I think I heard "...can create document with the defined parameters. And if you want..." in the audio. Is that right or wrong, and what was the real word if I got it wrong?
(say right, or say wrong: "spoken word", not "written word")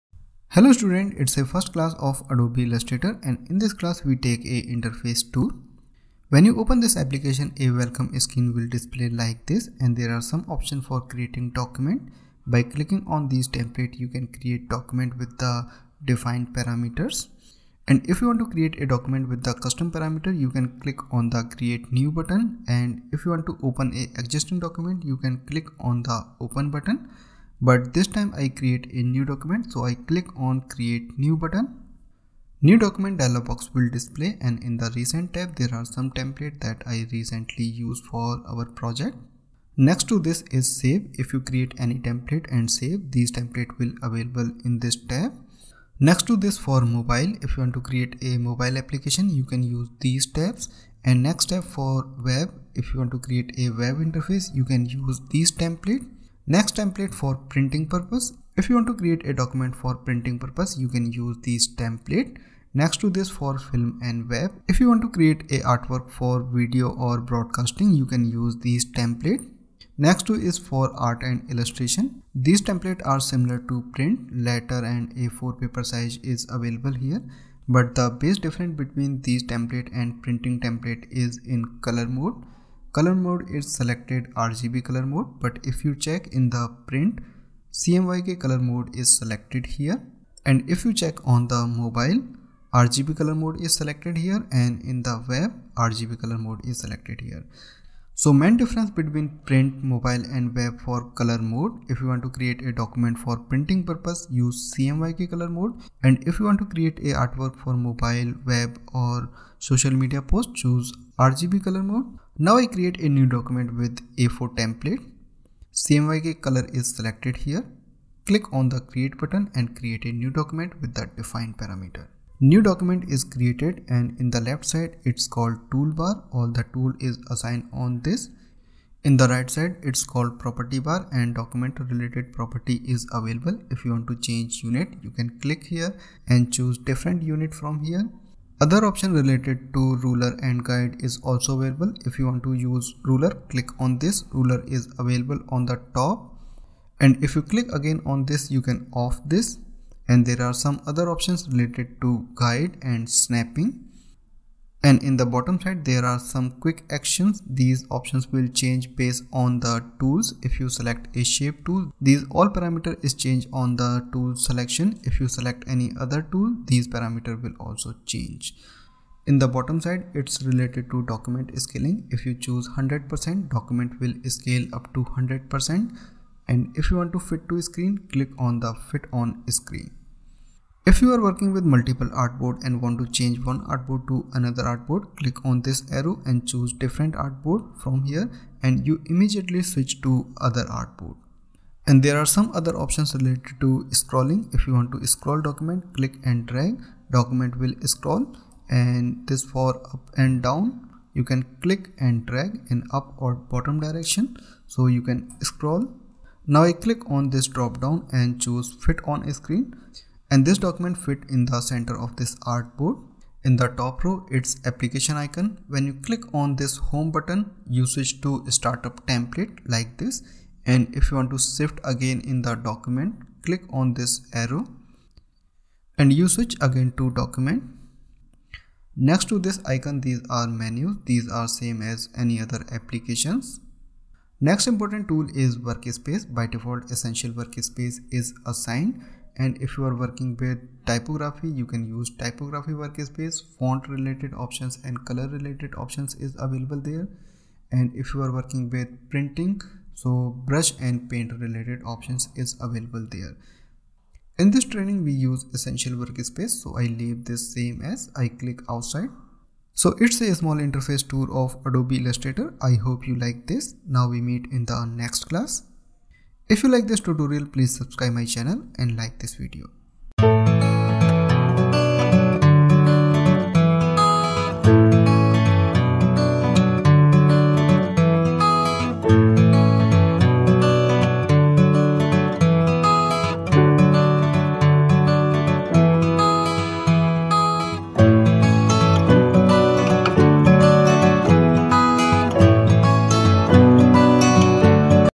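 right.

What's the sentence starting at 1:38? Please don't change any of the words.
So main difference between print, mobile and web for color mode.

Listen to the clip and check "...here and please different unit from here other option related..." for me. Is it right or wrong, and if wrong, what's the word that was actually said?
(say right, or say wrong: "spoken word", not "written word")
wrong: "choose", not "please".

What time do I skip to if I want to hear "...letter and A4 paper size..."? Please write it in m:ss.
1:14.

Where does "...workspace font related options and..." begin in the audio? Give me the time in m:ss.
4:02.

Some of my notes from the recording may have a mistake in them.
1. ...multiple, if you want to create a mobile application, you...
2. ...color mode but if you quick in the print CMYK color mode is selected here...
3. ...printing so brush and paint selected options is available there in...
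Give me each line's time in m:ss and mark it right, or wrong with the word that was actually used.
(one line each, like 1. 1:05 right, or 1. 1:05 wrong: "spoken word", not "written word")
1. 0:46 wrong: "mobile", not "multiple"
2. 1:24 wrong: "check", not "quick"
3. 4:09 wrong: "related", not "selected".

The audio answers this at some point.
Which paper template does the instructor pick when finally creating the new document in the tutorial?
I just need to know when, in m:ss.
1:54.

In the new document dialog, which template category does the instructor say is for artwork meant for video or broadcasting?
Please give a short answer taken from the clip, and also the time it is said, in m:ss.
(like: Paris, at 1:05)
Film and web, at 1:03.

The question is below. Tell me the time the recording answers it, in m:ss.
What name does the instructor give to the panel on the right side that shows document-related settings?
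2:10.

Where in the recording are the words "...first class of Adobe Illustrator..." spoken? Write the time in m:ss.
0:01.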